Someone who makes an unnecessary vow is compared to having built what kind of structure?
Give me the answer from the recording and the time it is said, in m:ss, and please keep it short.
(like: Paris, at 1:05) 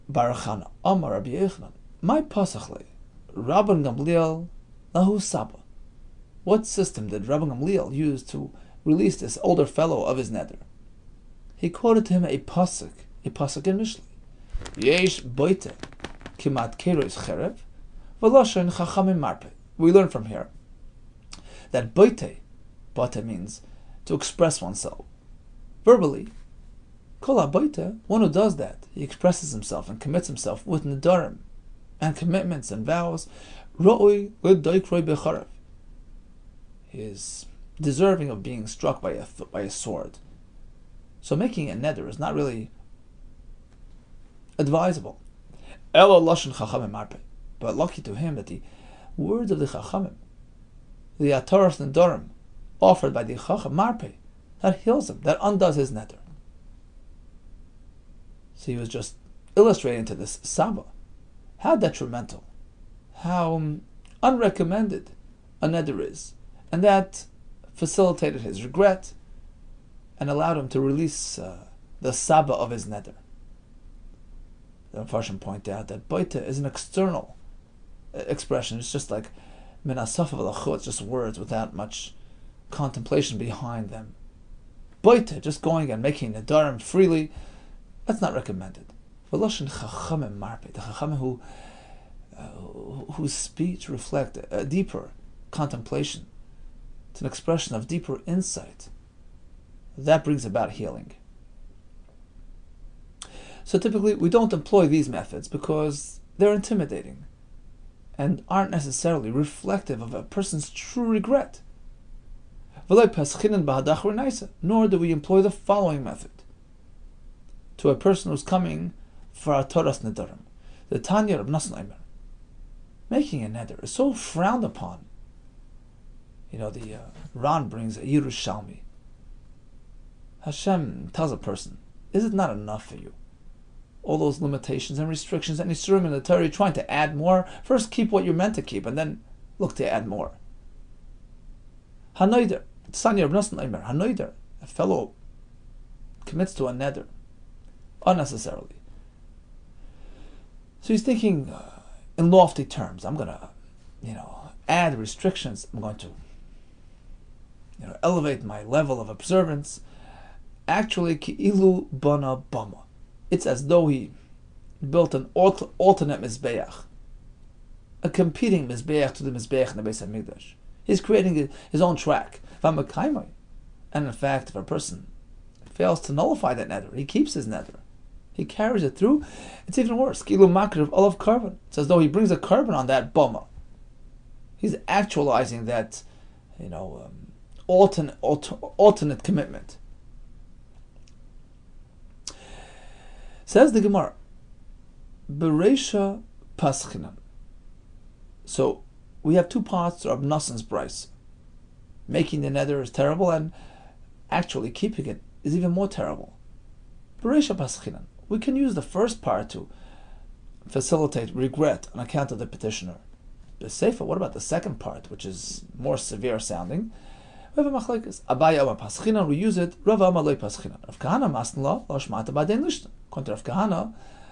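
An alternate Mizbeach, at 2:45.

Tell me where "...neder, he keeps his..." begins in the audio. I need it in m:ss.
2:56.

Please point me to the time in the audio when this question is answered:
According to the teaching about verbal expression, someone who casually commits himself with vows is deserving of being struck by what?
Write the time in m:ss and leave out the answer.
0:35.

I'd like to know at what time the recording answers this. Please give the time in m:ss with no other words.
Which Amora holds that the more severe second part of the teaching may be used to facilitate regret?
3:38.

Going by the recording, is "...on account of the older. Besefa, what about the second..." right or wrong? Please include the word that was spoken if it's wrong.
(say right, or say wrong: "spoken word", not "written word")
wrong: "petitioner", not "older".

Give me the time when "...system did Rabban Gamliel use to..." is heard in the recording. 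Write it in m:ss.
0:06.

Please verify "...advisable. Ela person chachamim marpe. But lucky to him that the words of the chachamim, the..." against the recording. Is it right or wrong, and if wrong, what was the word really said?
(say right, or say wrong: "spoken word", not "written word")
wrong: "lashon", not "person".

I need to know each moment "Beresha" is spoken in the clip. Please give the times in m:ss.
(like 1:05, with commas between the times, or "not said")
3:15, 3:27.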